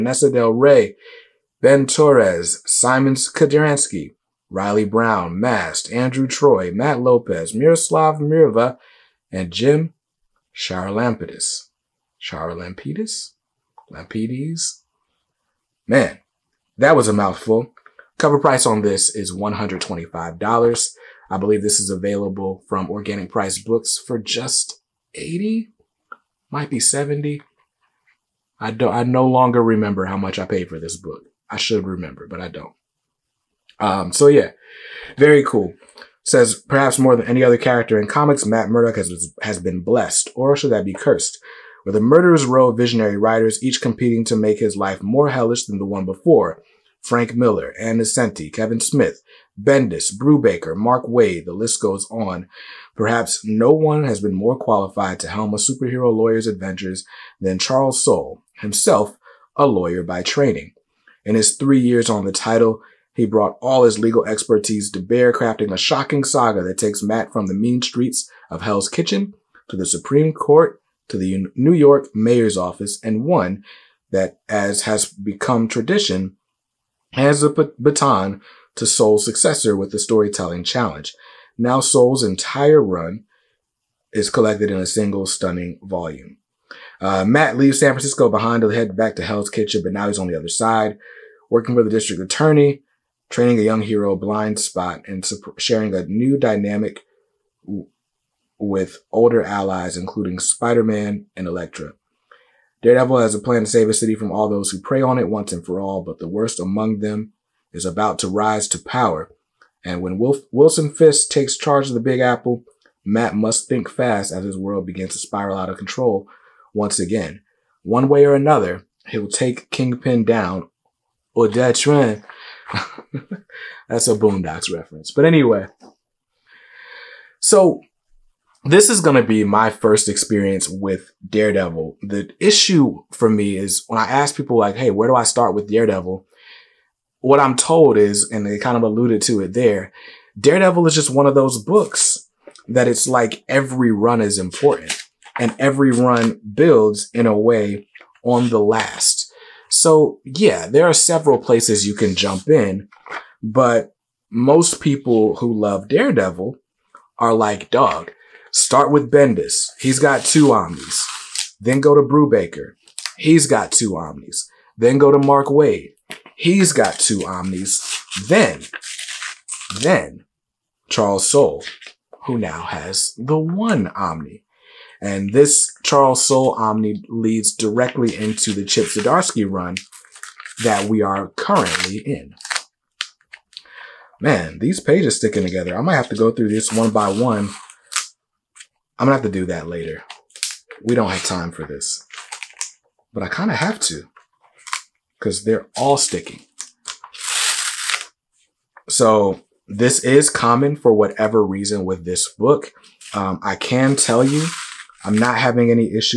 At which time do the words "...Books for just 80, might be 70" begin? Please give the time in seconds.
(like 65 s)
23 s.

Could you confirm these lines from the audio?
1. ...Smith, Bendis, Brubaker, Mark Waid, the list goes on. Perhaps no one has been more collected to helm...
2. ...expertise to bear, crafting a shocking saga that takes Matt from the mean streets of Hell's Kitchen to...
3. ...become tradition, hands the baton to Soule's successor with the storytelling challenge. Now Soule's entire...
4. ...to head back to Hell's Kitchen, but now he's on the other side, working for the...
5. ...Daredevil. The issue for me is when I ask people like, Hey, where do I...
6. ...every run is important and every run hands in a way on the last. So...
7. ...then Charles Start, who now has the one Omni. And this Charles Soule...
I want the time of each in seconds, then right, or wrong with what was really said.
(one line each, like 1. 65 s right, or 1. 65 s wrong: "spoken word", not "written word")
1. 48 s wrong: "qualified", not "collected"
2. 64 s right
3. 75 s right
4. 88 s right
5. 131 s right
6. 143 s wrong: "builds", not "hands"
7. 169 s wrong: "Soule", not "Start".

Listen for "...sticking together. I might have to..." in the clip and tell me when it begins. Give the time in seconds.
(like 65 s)
185 s.